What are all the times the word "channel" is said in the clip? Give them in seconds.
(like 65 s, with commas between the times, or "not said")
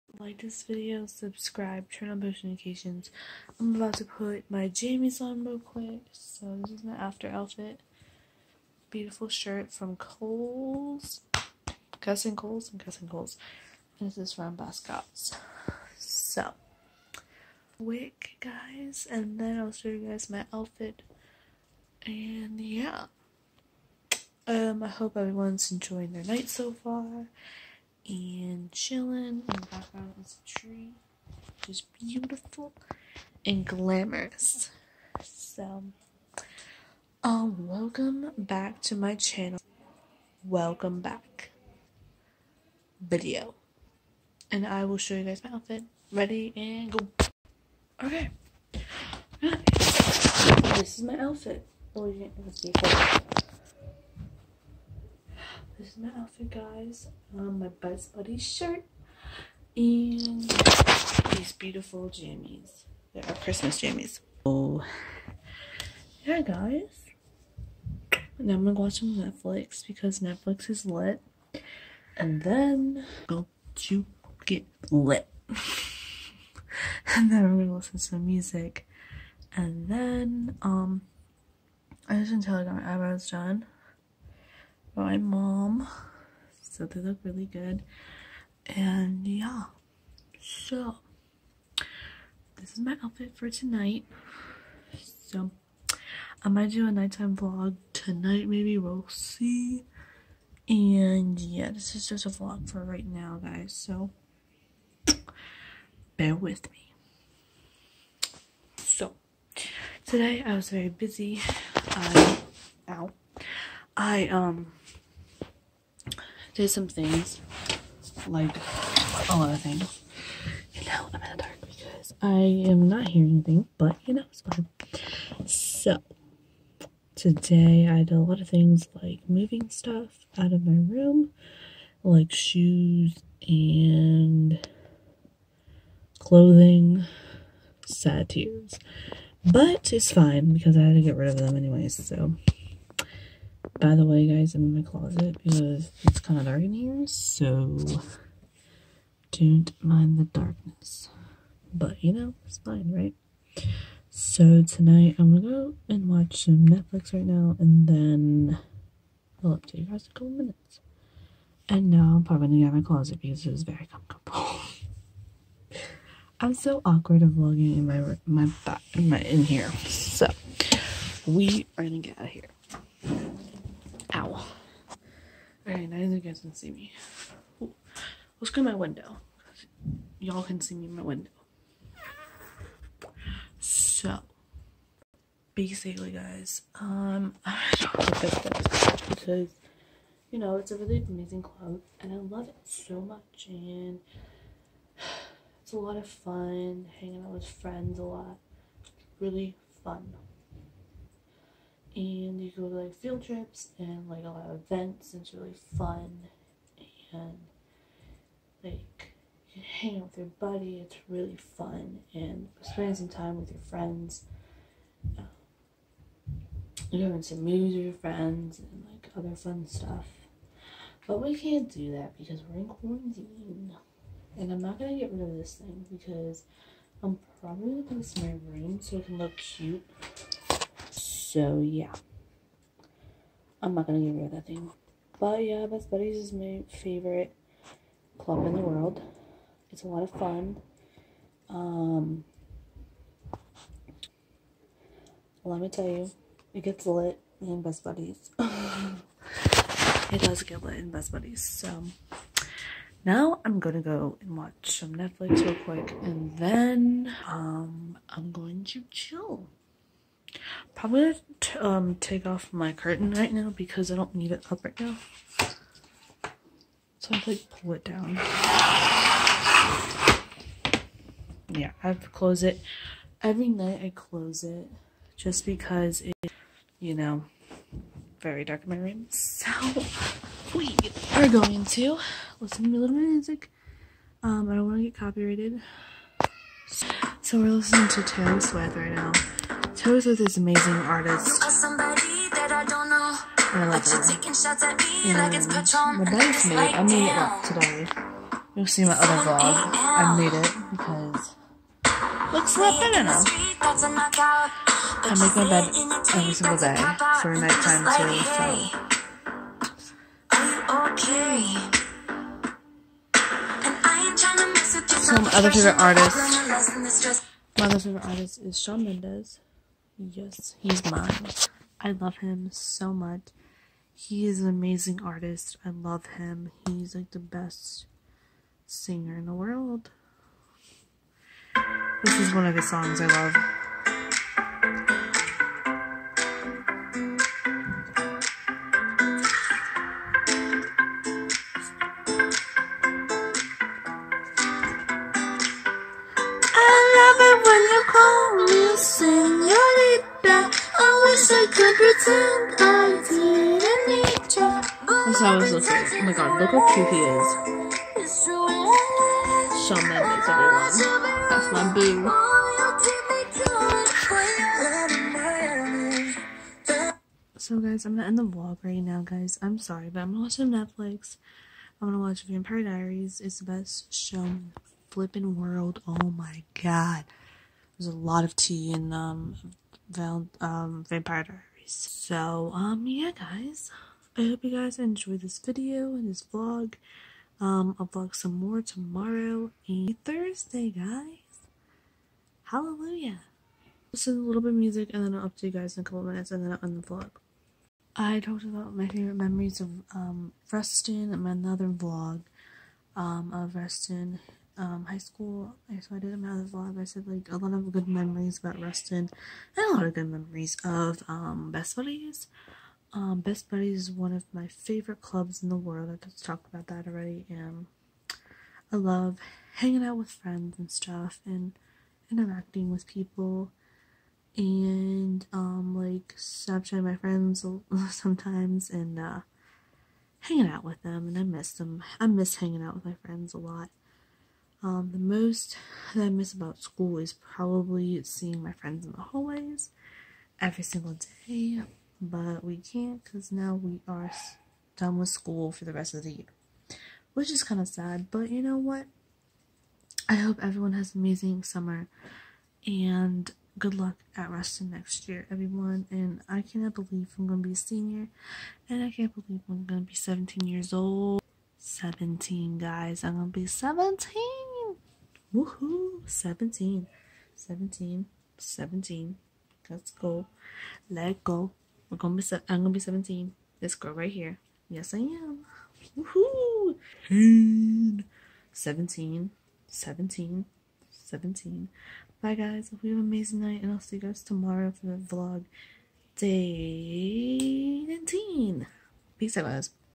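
39 s.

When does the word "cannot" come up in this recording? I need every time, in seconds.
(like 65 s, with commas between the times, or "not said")
456 s.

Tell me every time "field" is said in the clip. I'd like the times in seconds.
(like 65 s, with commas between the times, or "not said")
202 s.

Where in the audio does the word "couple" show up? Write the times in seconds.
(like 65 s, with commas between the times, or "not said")
160 s, 395 s.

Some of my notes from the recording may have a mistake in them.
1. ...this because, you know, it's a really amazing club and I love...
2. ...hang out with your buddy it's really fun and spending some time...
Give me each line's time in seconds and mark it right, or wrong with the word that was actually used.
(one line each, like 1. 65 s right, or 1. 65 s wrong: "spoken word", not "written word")
1. 188 s right
2. 209 s right.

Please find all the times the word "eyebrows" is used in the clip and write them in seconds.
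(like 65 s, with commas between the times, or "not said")
82 s.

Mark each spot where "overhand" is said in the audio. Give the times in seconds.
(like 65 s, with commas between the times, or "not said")
not said.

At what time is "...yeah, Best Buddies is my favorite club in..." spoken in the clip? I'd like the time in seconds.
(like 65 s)
235 s.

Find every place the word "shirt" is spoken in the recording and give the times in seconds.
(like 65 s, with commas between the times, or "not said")
9 s, 58 s.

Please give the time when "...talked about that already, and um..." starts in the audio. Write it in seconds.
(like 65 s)
416 s.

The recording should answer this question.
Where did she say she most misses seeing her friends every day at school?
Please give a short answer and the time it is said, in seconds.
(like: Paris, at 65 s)
the hallways, at 439 s.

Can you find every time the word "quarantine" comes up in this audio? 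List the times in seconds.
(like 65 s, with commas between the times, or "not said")
222 s.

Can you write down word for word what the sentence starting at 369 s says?
I'm sorry, but I'm gonna watch some Netflix.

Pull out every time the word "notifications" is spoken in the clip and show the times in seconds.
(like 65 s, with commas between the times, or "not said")
2 s.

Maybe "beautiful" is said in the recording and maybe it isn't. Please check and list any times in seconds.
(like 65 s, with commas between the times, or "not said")
8 s, 31 s, 61 s.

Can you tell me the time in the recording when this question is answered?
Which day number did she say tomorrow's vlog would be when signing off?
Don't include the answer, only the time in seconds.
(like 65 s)
486 s.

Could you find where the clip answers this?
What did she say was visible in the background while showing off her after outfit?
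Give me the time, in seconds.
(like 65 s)
30 s.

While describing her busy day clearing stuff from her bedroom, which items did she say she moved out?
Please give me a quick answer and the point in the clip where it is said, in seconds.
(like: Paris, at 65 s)
shoes and clothing, at 132 s.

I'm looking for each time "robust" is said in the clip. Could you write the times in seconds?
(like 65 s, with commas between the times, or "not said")
not said.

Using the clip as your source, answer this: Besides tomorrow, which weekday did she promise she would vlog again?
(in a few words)
Thursday.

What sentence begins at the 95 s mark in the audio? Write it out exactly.
So I'm gonna do a nighttime vlog tonight, maybe we'll see.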